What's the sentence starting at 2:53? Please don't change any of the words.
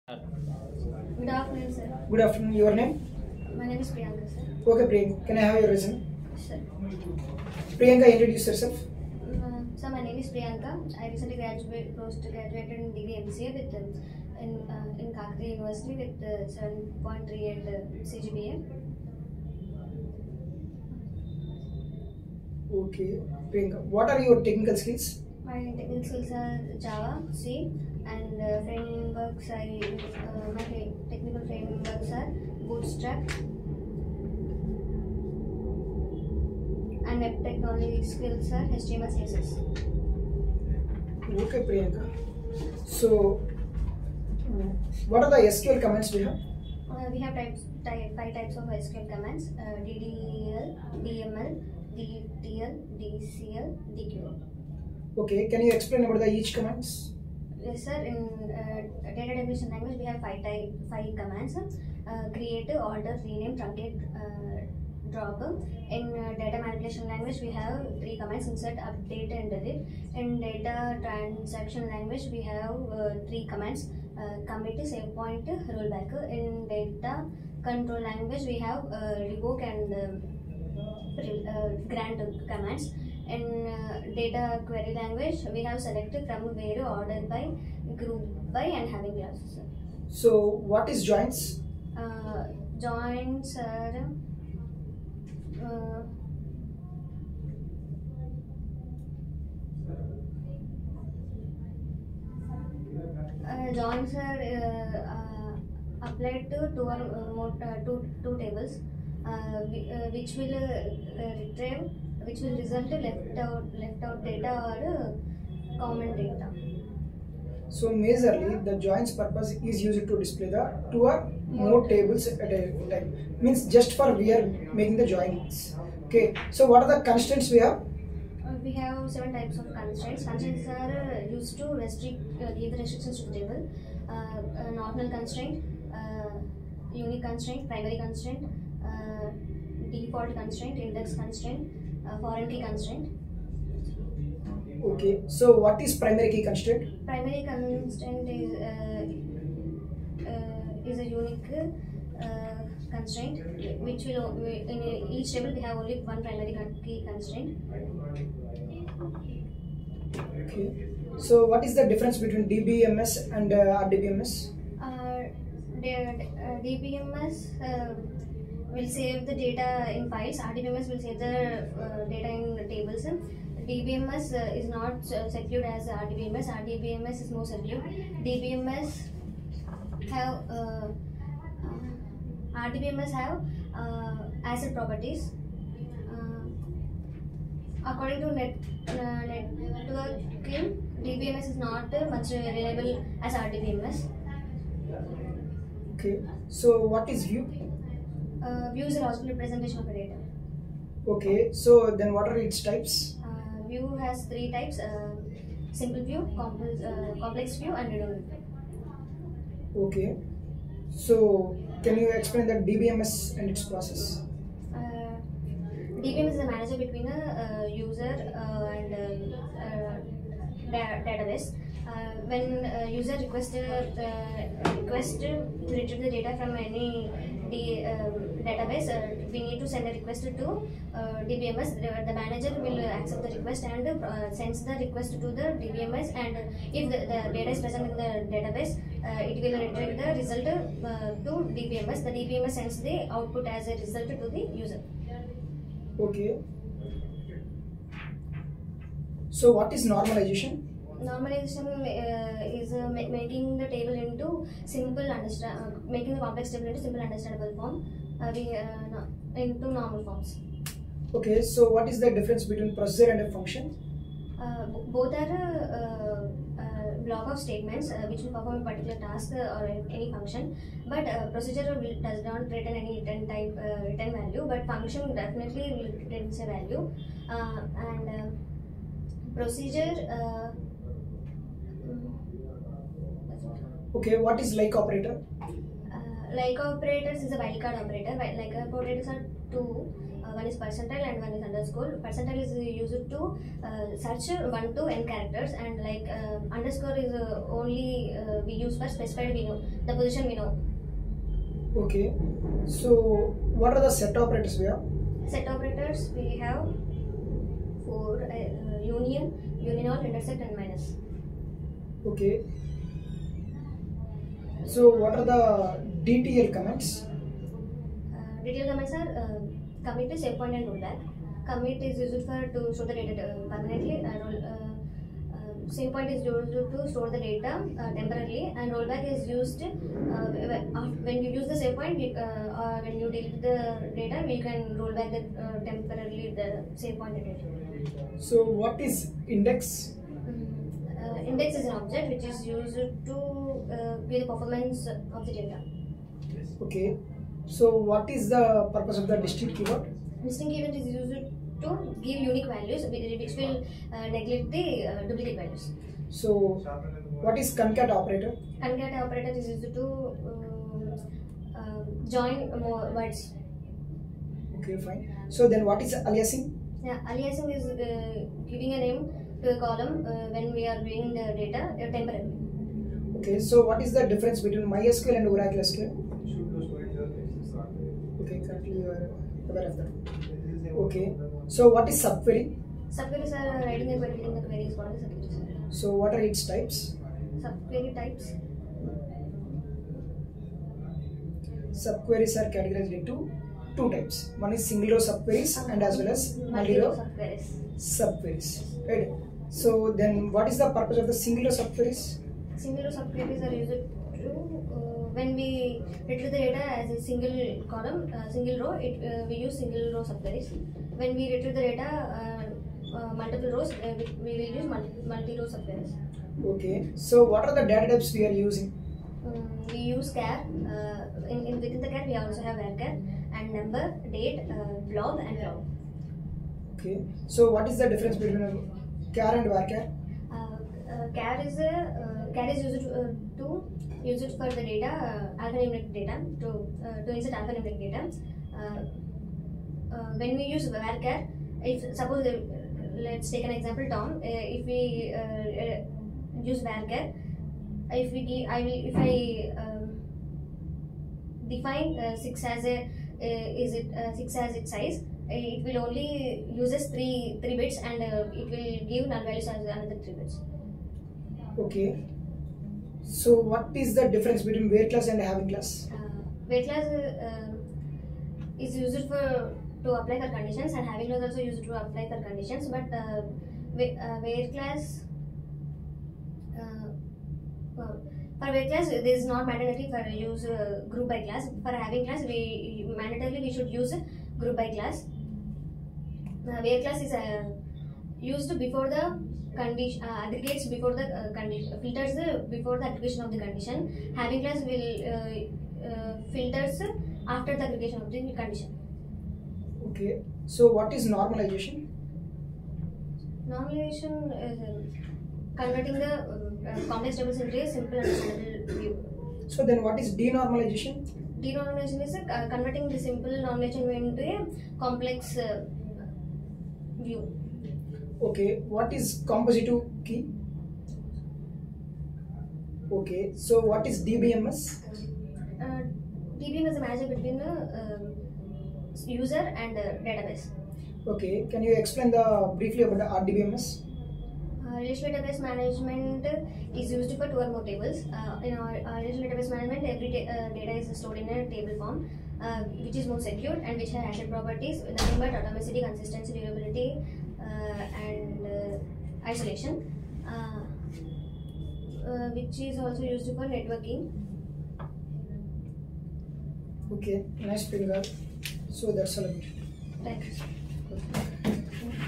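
DBMS uh, is not uh, secured as RDBMS, RDBMS is more secured.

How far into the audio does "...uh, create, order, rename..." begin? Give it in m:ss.
1:02.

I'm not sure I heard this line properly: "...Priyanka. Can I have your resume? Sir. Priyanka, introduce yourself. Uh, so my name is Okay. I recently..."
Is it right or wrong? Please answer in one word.
wrong.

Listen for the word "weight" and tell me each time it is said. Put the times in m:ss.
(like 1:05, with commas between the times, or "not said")
7:54, 7:58, 8:06.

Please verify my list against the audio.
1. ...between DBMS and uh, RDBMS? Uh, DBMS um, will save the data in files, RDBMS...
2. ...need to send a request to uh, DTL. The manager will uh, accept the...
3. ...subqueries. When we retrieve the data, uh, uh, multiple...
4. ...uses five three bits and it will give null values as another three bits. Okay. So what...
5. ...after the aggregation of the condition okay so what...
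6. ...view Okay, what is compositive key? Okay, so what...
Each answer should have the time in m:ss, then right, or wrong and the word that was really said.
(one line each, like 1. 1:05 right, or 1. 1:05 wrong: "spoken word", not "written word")
1. 2:42 right
2. 3:49 wrong: "DBMS", not "DTL"
3. 6:50 right
4. 7:36 wrong: "three", not "five"
5. 8:17 right
6. 8:37 right.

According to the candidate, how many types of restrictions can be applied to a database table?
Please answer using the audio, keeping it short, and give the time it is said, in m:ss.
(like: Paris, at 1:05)
7, at 2:09.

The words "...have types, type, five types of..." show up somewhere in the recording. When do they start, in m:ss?
0:47.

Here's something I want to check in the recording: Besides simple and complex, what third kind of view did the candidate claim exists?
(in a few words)
redundant view.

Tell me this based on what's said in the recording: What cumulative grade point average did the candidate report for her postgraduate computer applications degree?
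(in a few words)
7.38.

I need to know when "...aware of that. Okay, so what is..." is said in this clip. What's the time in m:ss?
6:19.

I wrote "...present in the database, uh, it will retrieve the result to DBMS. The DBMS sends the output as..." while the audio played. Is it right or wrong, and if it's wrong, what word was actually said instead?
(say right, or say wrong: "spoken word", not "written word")
right.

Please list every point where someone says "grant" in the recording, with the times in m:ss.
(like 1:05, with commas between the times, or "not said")
1:21.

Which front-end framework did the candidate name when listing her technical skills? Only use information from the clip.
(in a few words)
Bootstrap.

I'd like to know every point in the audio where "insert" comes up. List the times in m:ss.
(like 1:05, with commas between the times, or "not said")
1:08, 7:17.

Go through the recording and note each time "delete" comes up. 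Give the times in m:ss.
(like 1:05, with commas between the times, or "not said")
1:09, 5:33.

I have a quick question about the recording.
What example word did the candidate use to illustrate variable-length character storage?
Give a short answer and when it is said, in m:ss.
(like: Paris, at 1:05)
Tom, at 7:23.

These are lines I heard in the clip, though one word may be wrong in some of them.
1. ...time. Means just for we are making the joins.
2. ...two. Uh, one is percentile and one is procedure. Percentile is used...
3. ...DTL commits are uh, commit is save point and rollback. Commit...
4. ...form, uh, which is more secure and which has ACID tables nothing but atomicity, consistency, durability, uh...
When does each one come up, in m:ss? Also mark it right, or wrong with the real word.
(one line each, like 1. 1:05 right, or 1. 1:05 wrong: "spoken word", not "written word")
1. 2:02 right
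2. 4:49 wrong: "underscore", not "procedure"
3. 5:18 right
4. 9:01 wrong: "properties", not "tables".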